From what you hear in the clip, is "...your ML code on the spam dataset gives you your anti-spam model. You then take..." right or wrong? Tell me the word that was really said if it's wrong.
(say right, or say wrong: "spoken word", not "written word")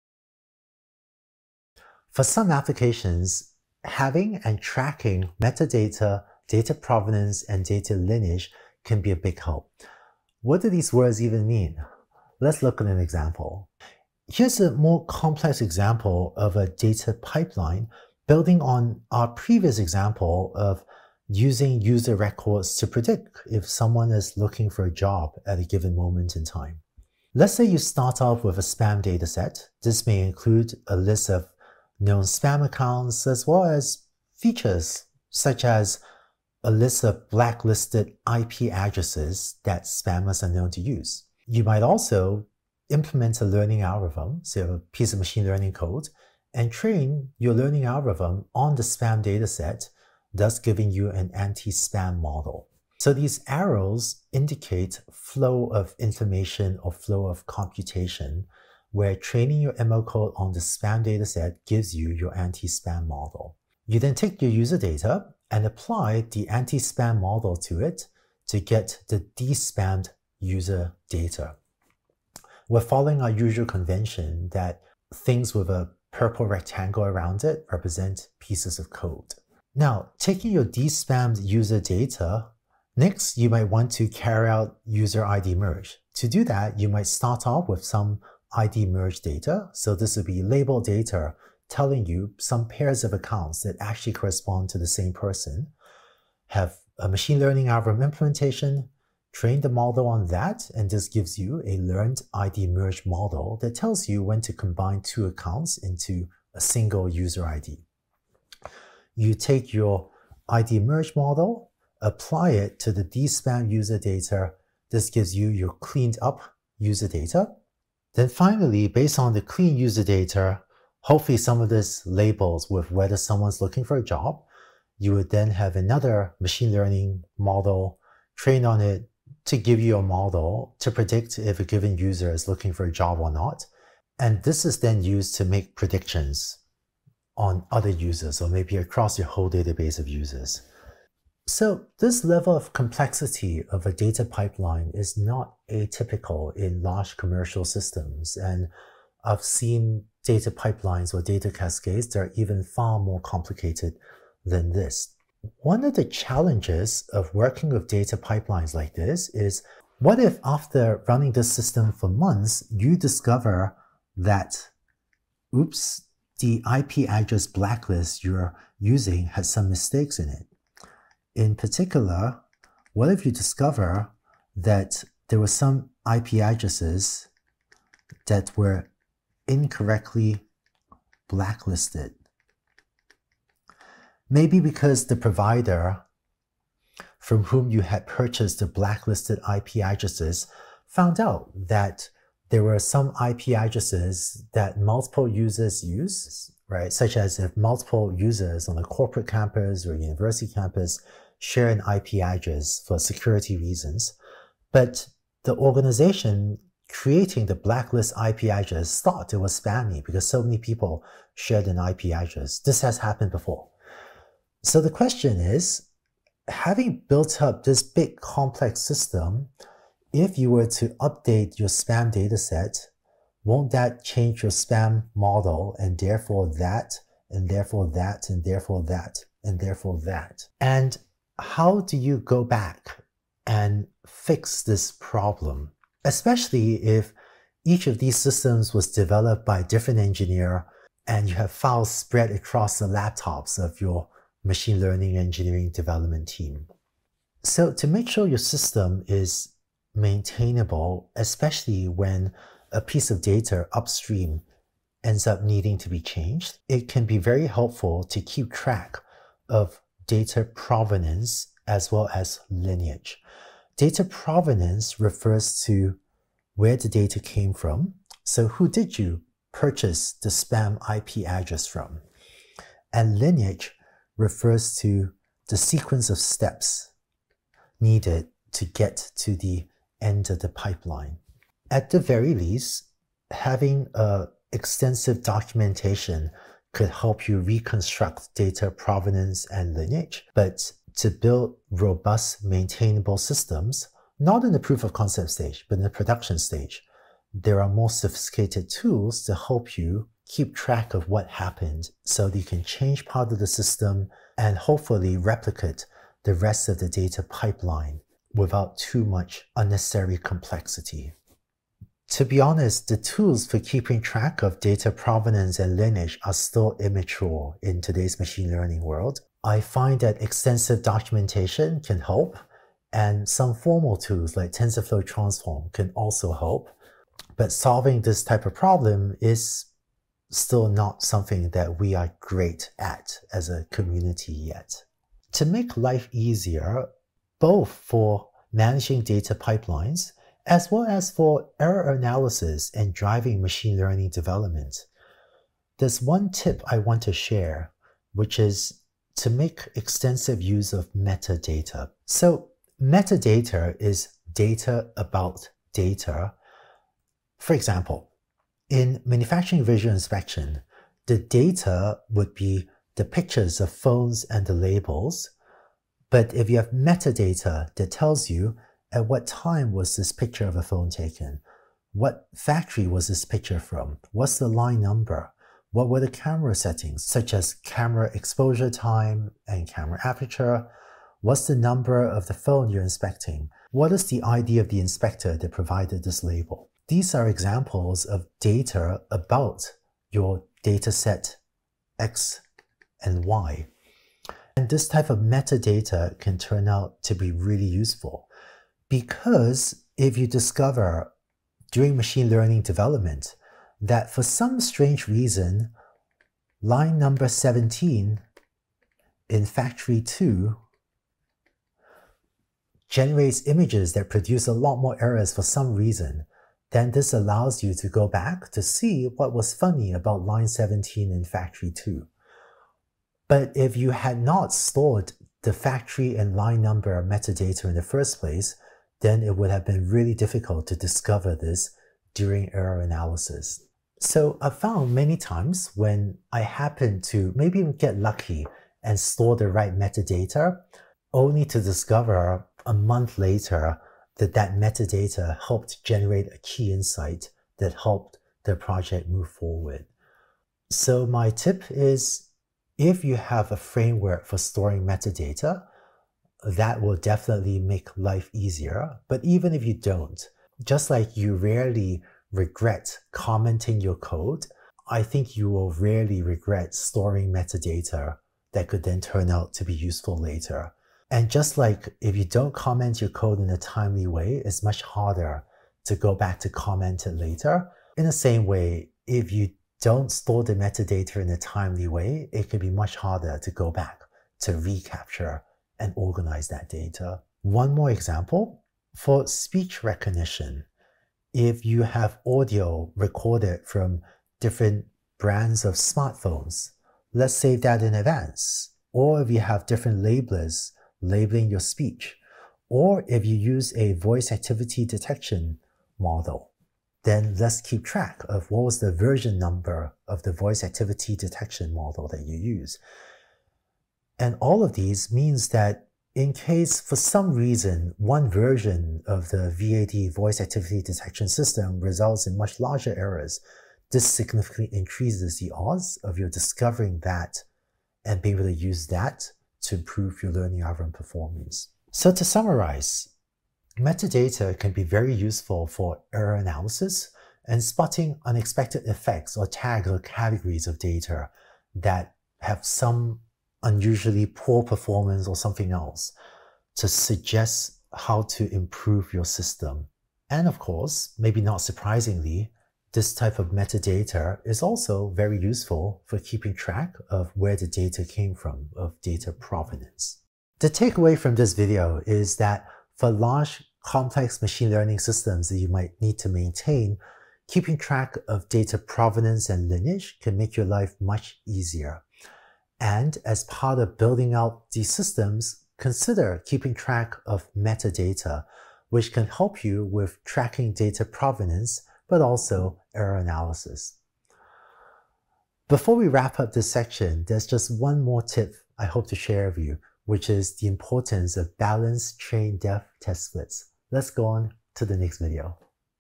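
right.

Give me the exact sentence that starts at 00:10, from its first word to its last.
What do these words even mean?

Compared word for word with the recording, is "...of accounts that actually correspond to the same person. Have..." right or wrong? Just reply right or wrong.
right.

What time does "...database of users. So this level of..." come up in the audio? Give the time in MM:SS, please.
02:19.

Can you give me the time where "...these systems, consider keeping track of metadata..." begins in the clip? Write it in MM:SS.
09:34.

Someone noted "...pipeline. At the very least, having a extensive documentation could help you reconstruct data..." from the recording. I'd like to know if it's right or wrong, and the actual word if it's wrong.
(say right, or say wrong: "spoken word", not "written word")
right.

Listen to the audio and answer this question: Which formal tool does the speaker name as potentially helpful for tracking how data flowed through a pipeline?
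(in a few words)
TensorFlow Transform.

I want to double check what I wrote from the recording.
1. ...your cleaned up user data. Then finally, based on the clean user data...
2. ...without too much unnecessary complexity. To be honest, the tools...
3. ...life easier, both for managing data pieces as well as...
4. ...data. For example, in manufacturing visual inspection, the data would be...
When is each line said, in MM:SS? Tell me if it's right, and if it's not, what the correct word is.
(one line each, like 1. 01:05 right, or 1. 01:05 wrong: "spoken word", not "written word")
1. 01:55 right
2. 05:08 right
3. 05:35 wrong: "pipelines", not "pieces"
4. 05:55 right.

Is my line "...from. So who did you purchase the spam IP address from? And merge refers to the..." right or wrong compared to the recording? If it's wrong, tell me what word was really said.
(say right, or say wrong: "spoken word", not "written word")
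wrong: "lineage", not "merge".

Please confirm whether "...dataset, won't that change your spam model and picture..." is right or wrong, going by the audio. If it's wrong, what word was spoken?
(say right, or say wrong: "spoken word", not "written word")
wrong: "therefore", not "picture".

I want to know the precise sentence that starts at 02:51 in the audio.
In particular, what if you discover that there were some IP addresses that were incorrectly blacklisted?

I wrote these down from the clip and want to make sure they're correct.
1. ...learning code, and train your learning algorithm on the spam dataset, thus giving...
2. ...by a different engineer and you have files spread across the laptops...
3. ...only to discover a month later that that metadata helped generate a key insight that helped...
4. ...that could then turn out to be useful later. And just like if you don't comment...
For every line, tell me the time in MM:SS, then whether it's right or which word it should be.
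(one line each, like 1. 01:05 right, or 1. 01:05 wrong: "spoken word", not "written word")
1. 00:45 right
2. 03:59 right
3. 07:21 right
4. 07:48 right.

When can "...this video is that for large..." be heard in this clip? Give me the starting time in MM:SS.
09:21.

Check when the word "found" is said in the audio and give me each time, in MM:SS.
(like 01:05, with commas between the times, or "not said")
03:10, 07:14.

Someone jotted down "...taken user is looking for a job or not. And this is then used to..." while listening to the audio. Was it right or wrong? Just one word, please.
wrong.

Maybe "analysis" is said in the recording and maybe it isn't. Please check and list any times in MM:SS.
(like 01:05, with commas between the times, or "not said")
05:41, 07:12, 08:56, 09:43.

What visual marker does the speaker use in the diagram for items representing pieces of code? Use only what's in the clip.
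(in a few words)
purple rectangle.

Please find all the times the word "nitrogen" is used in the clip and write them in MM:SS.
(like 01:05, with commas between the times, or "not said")
not said.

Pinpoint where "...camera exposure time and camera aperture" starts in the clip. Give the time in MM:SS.
06:17.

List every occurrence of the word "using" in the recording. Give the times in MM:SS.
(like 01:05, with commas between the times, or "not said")
00:21, 02:48.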